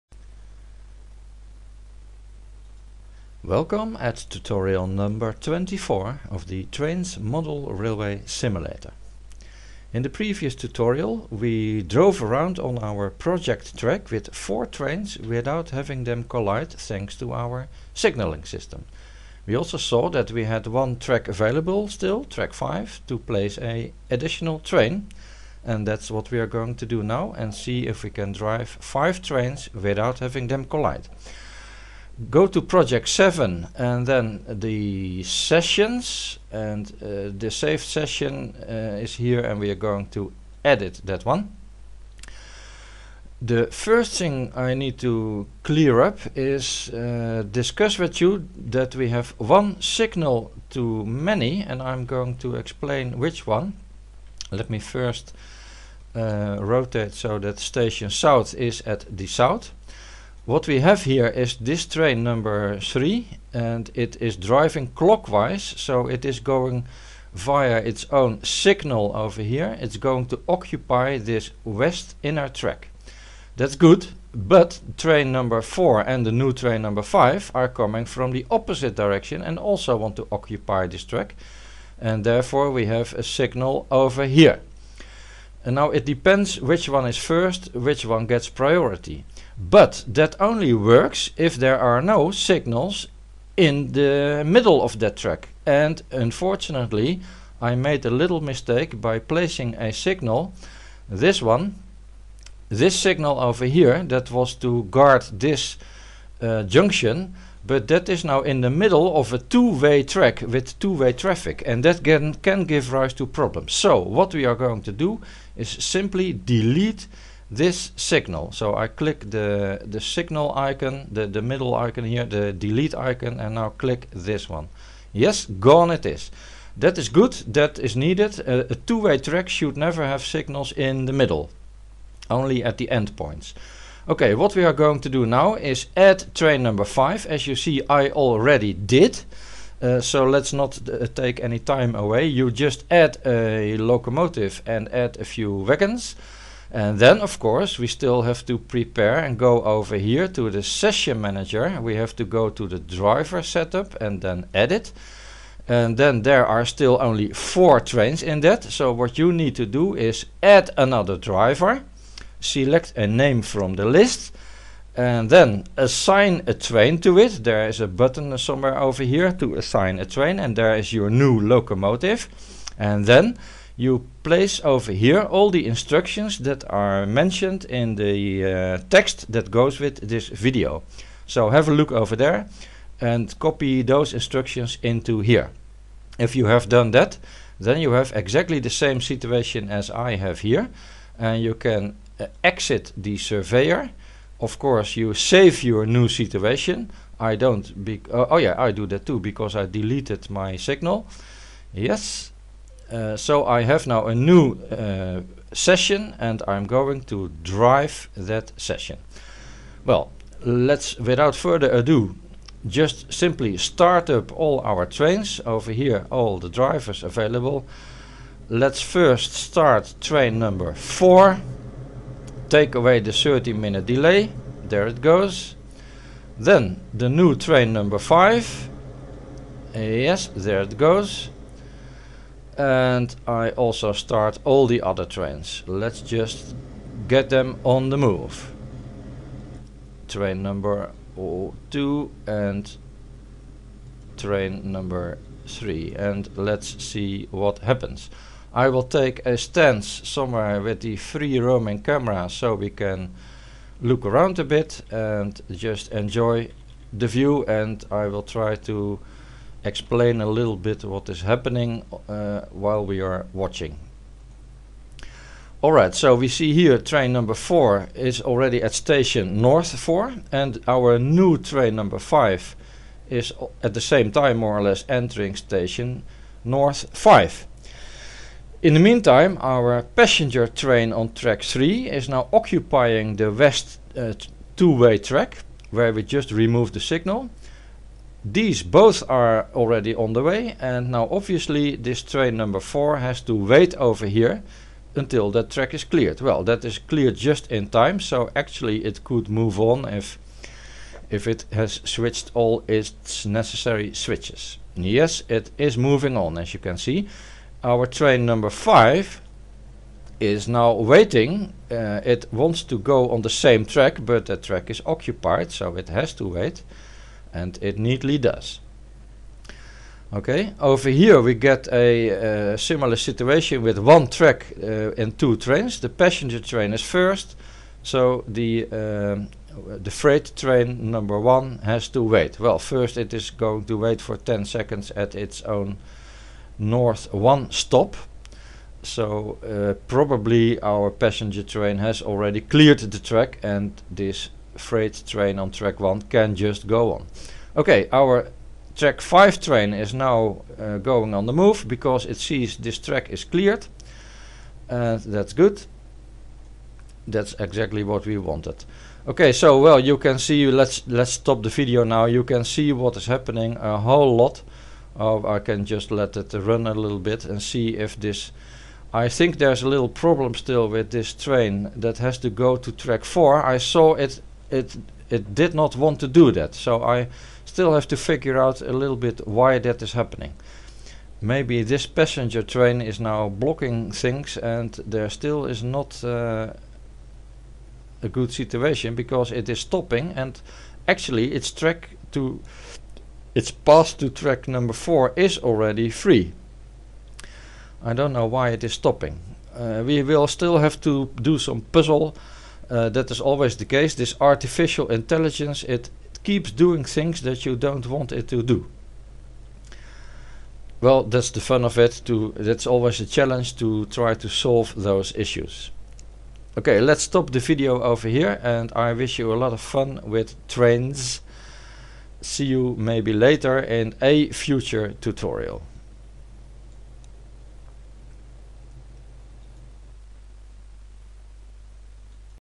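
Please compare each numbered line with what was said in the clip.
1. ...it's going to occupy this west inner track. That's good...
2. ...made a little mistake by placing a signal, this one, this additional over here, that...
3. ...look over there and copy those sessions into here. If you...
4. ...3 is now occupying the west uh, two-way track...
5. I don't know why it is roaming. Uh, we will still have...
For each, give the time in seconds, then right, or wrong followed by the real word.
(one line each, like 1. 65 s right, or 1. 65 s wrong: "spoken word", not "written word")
1. 69 s right
2. 97 s wrong: "signal", not "additional"
3. 181 s wrong: "instructions", not "sessions"
4. 281 s right
5. 397 s wrong: "stopping", not "roaming".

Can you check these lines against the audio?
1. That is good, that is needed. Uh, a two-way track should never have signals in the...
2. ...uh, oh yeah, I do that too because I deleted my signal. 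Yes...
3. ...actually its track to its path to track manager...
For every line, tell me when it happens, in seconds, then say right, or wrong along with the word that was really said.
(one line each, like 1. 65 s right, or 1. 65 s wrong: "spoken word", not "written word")
1. 126 s right
2. 198 s right
3. 390 s wrong: "number", not "manager".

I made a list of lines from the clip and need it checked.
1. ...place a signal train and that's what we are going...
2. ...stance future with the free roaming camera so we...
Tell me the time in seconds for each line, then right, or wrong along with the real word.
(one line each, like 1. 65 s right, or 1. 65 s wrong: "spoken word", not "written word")
1. 23 s wrong: "additional", not "signal"
2. 249 s wrong: "somewhere", not "future".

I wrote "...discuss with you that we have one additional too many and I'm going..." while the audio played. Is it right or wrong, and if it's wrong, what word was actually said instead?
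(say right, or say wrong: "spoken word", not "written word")
wrong: "signal", not "additional".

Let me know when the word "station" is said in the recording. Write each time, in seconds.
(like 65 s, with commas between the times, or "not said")
57 s, 268 s, 275 s.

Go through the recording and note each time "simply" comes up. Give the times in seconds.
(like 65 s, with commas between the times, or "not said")
115 s, 213 s.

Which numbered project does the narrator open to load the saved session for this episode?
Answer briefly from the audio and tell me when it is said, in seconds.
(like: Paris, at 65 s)
Project 7, at 32 s.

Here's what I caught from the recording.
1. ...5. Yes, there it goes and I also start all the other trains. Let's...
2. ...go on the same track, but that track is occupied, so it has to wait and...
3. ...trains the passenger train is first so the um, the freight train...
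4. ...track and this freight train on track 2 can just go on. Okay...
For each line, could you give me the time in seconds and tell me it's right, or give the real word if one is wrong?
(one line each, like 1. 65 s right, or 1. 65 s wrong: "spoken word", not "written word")
1. 227 s right
2. 312 s right
3. 325 s right
4. 342 s wrong: "1", not "2".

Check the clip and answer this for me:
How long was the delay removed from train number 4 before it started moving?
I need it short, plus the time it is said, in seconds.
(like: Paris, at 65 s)
30 minutes, at 223 s.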